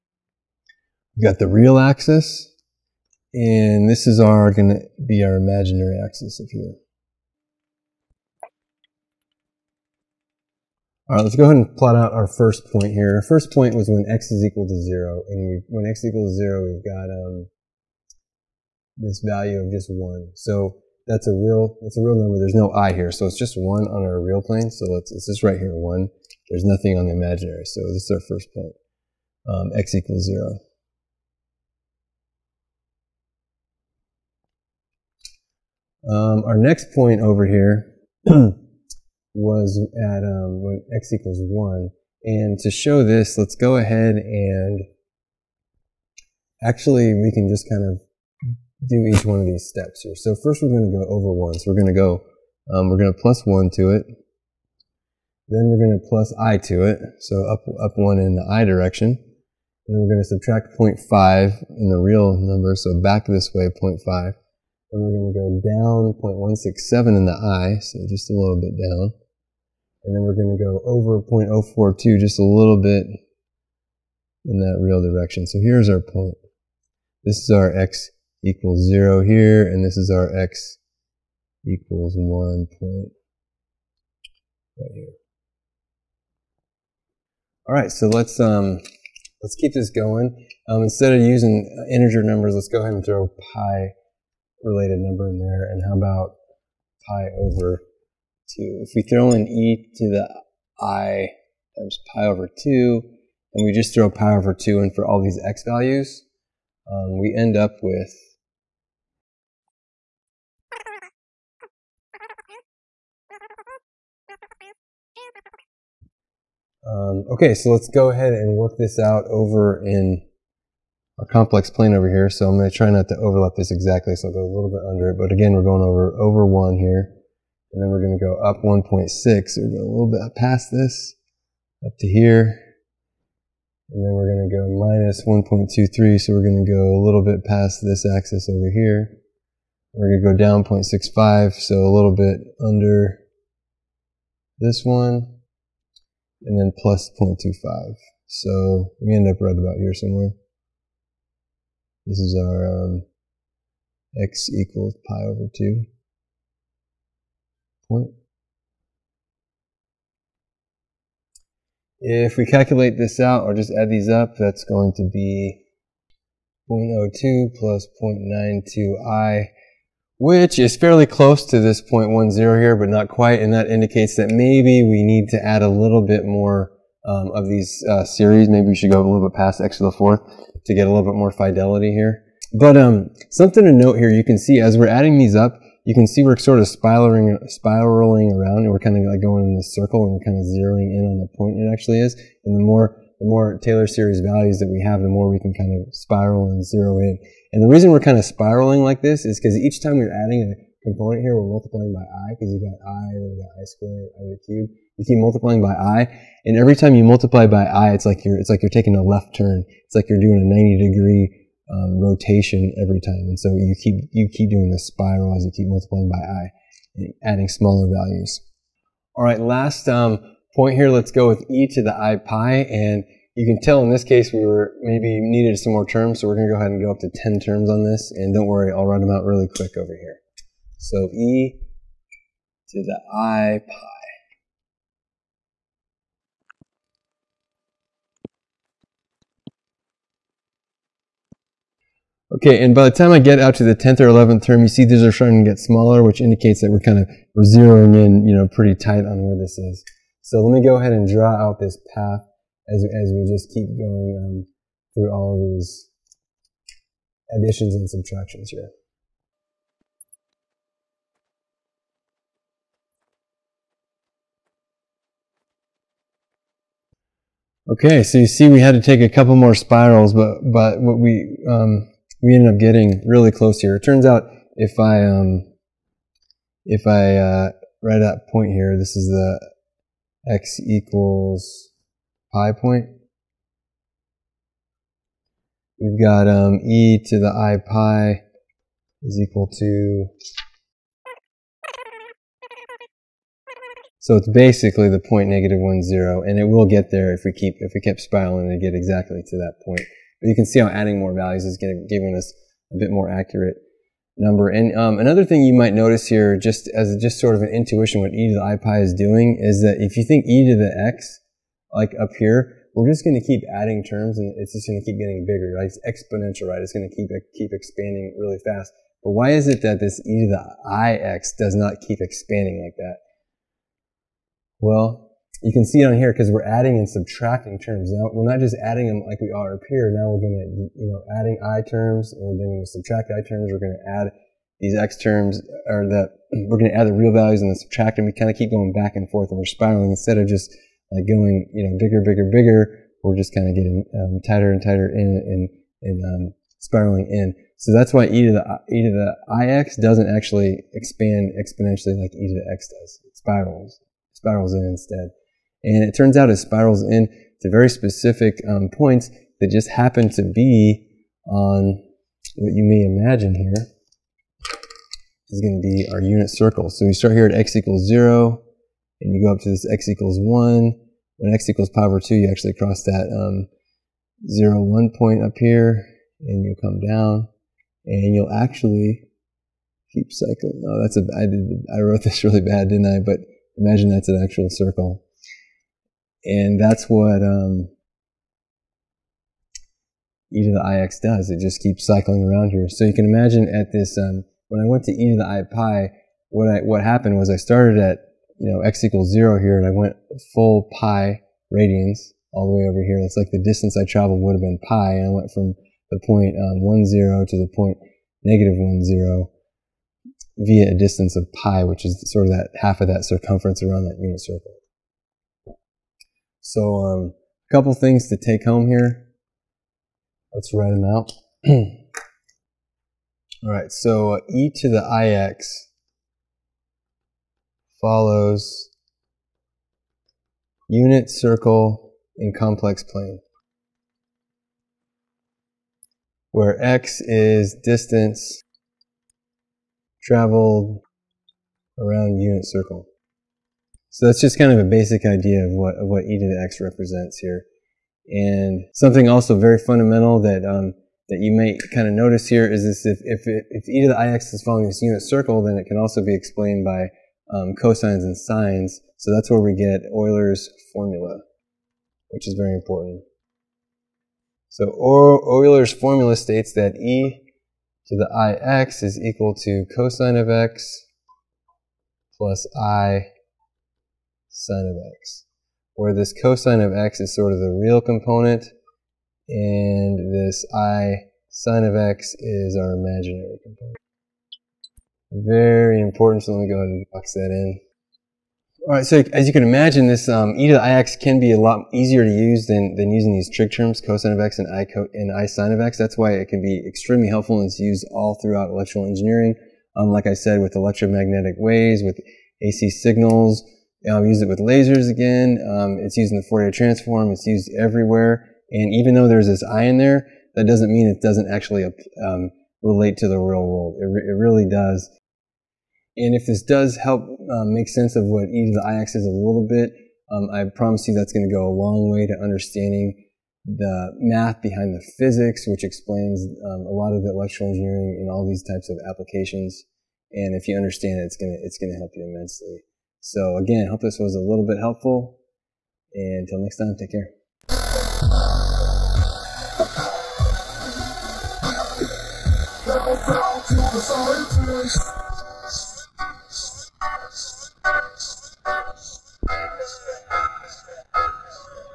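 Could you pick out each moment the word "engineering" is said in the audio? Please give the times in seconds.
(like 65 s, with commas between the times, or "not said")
498 s, 527 s.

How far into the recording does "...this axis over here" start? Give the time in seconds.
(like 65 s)
137 s.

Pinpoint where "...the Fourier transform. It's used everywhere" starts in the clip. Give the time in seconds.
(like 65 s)
506 s.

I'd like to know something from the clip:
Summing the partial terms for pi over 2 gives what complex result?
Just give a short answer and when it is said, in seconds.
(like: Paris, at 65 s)
0.02 plus 0.92i, at 166 s.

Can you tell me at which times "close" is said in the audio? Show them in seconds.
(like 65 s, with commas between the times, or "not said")
171 s, 273 s.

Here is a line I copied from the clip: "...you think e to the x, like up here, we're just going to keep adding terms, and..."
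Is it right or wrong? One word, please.
right.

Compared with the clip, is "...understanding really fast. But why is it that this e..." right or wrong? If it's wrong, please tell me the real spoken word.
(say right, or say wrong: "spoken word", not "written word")
wrong: "expanding", not "understanding".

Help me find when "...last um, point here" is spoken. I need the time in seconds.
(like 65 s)
219 s.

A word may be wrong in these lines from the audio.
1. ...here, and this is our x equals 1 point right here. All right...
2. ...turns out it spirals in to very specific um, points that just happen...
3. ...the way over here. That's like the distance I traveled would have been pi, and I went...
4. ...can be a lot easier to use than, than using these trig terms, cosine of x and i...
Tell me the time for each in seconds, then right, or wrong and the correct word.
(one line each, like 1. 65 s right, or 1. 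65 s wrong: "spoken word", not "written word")
1. 79 s right
2. 355 s right
3. 402 s right
4. 490 s right.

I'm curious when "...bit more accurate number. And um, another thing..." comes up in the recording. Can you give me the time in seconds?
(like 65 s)
302 s.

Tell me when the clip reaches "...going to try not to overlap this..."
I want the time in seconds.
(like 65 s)
122 s.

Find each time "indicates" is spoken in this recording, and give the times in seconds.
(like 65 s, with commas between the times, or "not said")
173 s, 246 s.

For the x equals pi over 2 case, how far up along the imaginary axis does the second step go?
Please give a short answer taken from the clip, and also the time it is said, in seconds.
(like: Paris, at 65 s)
1.6, at 128 s.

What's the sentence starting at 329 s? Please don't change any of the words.
Now we're going to, you know, adding i terms, and we're going to subtract i terms.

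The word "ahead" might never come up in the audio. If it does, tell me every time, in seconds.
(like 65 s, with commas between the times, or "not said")
11 s, 43 s, 92 s, 118 s, 226 s, 250 s, 486 s.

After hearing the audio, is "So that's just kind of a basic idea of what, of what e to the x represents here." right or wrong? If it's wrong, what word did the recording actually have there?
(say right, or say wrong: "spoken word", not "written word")
right.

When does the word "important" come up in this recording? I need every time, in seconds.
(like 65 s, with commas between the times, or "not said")
462 s, 485 s.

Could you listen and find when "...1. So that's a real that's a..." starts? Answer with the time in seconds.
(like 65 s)
19 s.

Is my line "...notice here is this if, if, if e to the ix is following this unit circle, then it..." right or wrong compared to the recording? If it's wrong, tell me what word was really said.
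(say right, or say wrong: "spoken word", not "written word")
right.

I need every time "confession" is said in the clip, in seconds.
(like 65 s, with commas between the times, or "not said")
not said.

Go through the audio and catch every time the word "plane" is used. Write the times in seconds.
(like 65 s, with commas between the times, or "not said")
24 s, 121 s, 432 s.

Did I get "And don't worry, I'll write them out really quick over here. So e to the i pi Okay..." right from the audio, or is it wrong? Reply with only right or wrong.
right.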